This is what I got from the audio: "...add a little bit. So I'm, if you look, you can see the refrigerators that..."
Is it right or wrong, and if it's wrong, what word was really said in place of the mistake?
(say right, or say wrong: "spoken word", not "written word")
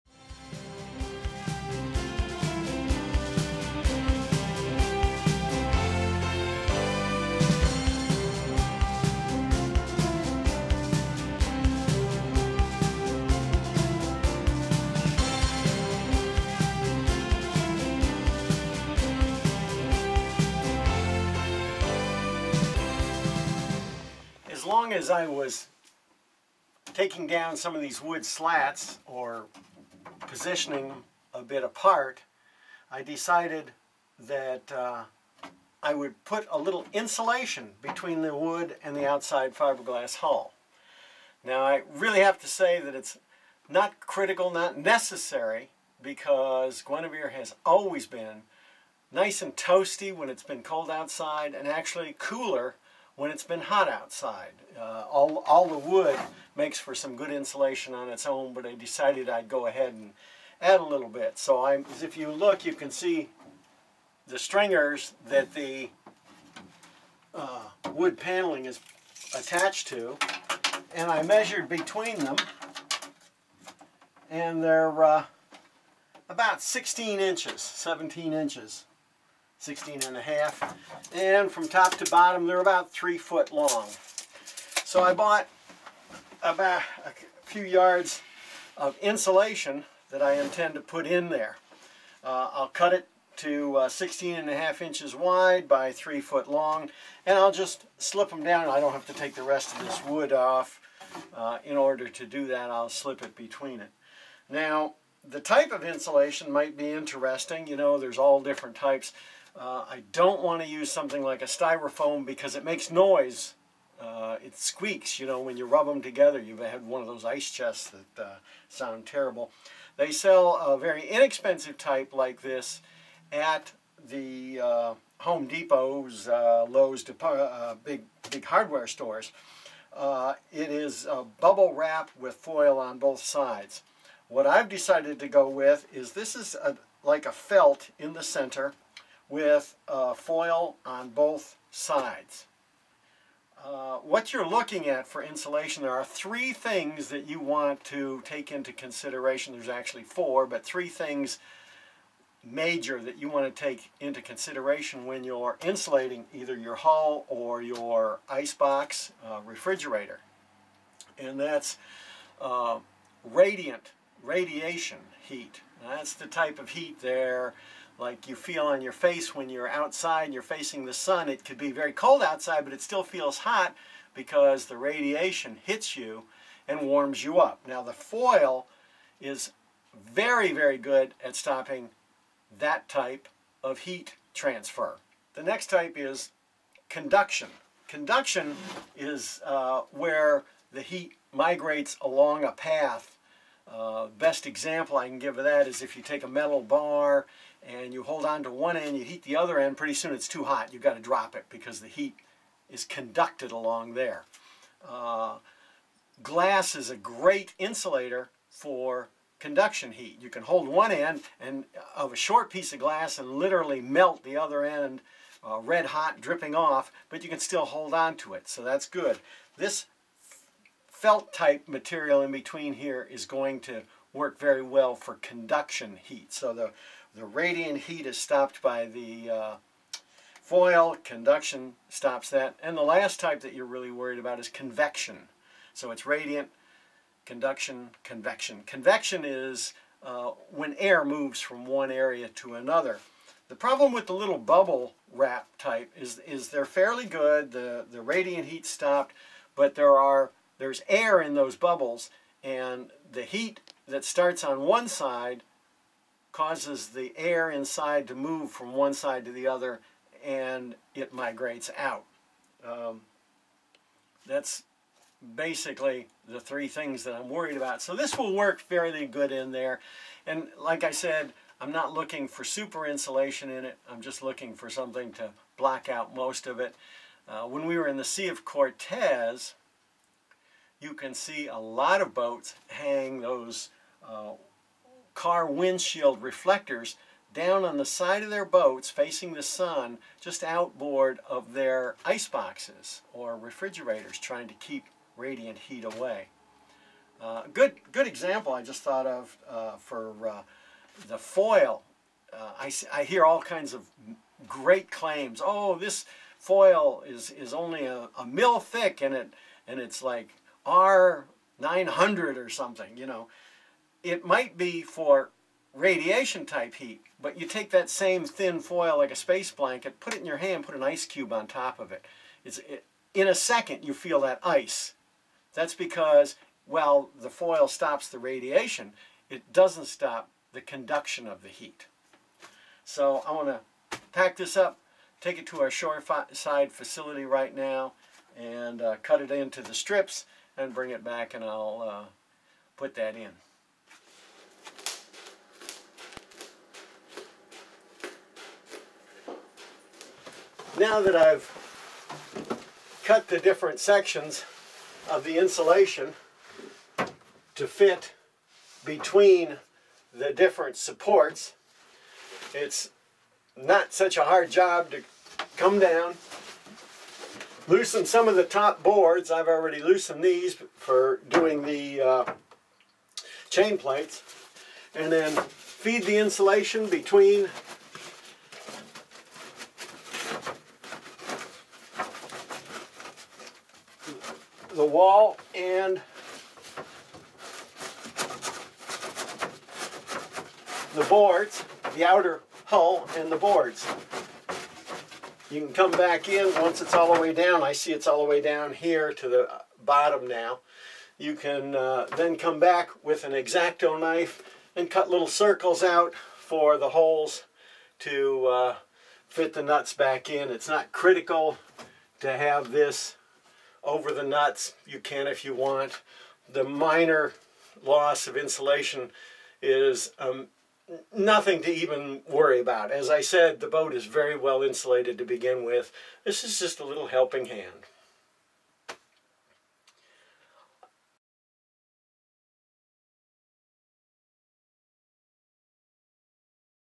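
wrong: "stringers", not "refrigerators".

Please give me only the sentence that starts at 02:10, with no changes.
it is bubble wrap with foil on both sides.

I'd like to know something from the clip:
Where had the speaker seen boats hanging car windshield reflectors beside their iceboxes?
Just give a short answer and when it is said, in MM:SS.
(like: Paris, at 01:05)
Sea of Cortez, at 04:38.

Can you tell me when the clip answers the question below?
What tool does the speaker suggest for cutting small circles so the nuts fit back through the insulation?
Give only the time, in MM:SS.
06:43.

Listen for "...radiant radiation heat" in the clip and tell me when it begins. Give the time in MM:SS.
02:43.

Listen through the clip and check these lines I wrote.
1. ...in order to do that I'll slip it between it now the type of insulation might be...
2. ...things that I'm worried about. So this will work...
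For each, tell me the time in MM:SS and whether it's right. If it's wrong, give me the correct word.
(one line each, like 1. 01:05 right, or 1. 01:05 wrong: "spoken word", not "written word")
1. 01:41 right
2. 04:26 right.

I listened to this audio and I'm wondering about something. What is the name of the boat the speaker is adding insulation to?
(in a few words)
Guenevere.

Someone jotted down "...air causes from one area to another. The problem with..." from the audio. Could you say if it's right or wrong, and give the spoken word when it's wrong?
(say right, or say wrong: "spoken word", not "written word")
wrong: "moves", not "causes".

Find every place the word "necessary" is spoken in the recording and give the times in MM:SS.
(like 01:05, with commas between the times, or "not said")
00:44.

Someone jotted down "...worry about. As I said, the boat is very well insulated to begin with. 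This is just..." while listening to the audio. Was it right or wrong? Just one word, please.
right.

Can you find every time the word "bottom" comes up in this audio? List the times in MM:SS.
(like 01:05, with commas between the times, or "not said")
01:22, 06:39.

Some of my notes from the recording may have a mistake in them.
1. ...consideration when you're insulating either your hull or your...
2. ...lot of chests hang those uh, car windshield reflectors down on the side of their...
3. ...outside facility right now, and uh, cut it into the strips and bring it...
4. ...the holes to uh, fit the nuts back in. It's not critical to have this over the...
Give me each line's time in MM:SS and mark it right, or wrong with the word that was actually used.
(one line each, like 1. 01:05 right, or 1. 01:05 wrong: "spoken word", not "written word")
1. 02:34 right
2. 04:41 wrong: "boats", not "chests"
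3. 05:35 wrong: "shoreside", not "outside"
4. 06:46 right.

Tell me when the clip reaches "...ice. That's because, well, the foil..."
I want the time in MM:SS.
05:24.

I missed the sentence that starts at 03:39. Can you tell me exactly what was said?
This felt type material in between here is going to work very well for conduction heat.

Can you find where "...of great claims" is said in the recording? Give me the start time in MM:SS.
05:03.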